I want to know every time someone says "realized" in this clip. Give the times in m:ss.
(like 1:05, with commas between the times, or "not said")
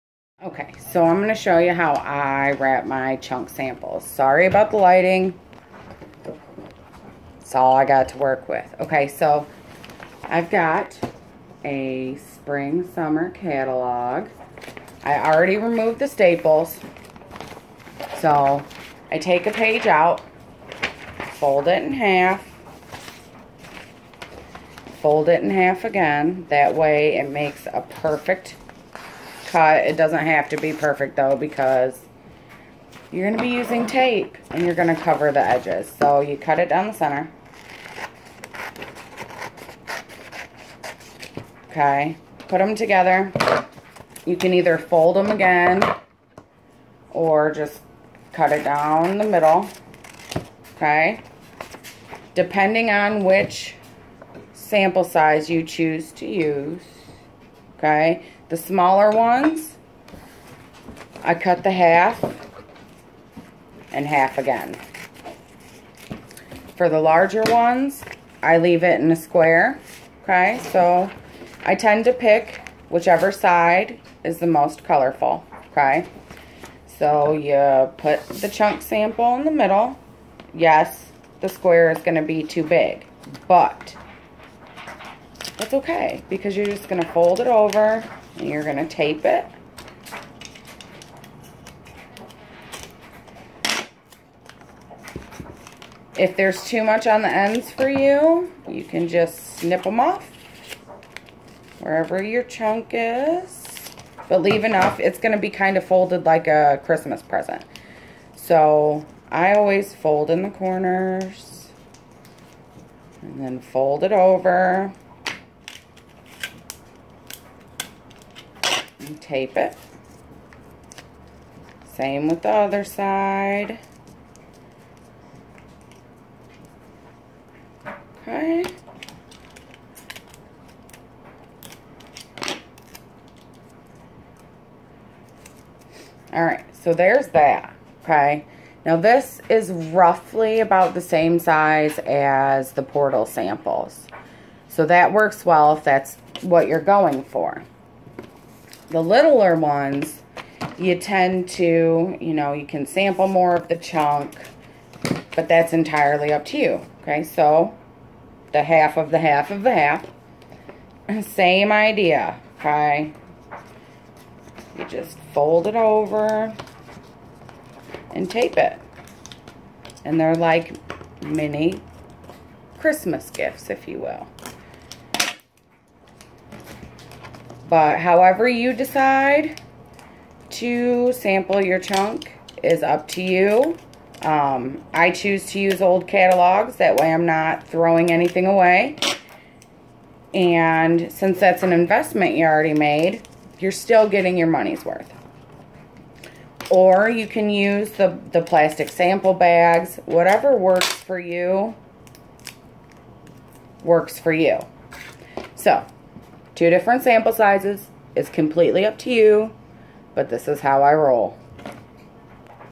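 not said.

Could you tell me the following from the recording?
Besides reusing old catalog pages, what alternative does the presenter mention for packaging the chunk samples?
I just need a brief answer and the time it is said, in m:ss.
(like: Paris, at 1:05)
Plastic sample bags, at 3:18.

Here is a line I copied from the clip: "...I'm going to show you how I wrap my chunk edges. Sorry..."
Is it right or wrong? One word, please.
wrong.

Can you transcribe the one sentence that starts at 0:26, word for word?
That way it makes a perfect cut.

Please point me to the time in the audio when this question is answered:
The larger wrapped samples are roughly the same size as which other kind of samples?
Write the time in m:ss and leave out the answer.
2:22.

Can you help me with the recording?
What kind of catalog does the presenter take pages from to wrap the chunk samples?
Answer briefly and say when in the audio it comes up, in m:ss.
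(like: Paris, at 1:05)
Spring summer catalog, at 0:12.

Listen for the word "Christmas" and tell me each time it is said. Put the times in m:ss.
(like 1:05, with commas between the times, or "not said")
1:46, 2:52.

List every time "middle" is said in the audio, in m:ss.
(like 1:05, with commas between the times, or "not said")
0:49, 1:19.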